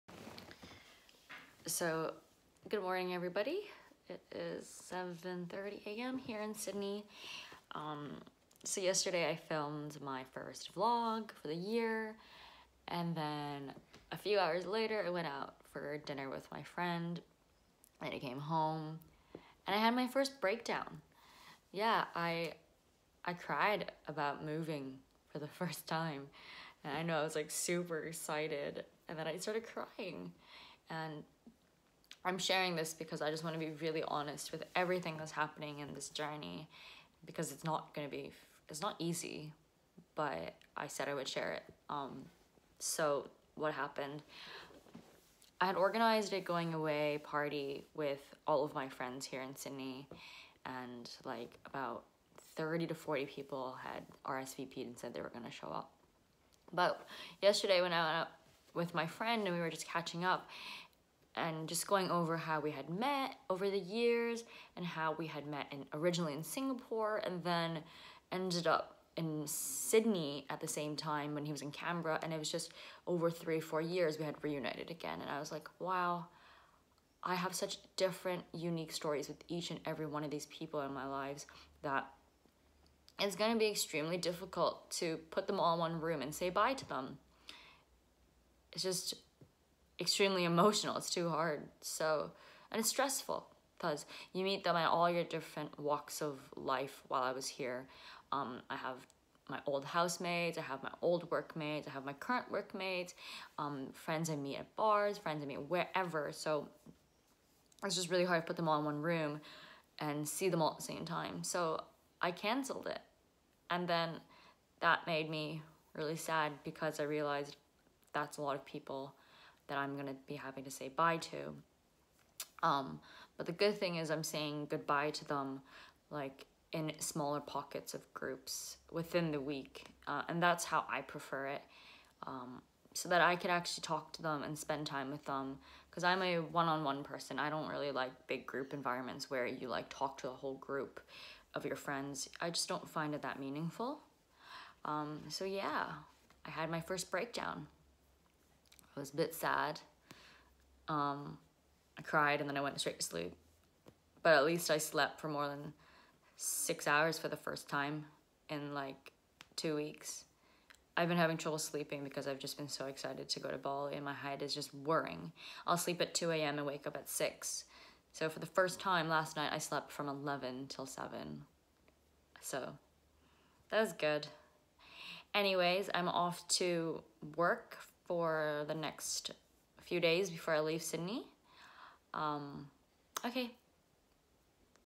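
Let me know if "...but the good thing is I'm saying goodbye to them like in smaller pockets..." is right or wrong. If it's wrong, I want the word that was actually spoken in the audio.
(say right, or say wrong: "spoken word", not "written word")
right.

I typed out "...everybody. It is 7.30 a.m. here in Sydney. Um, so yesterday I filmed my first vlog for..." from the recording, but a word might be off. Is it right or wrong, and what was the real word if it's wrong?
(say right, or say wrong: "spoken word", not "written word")
right.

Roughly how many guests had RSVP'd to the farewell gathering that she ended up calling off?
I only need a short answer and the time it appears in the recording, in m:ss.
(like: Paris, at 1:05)
30 to 40, at 0:52.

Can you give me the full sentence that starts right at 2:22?
I just don't find it that meaningful.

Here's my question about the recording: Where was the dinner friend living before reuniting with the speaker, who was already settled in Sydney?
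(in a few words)
Canberra.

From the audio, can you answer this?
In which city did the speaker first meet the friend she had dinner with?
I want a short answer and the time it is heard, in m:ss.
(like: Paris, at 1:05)
Singapore, at 1:06.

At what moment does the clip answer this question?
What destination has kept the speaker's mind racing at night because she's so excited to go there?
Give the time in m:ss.
2:43.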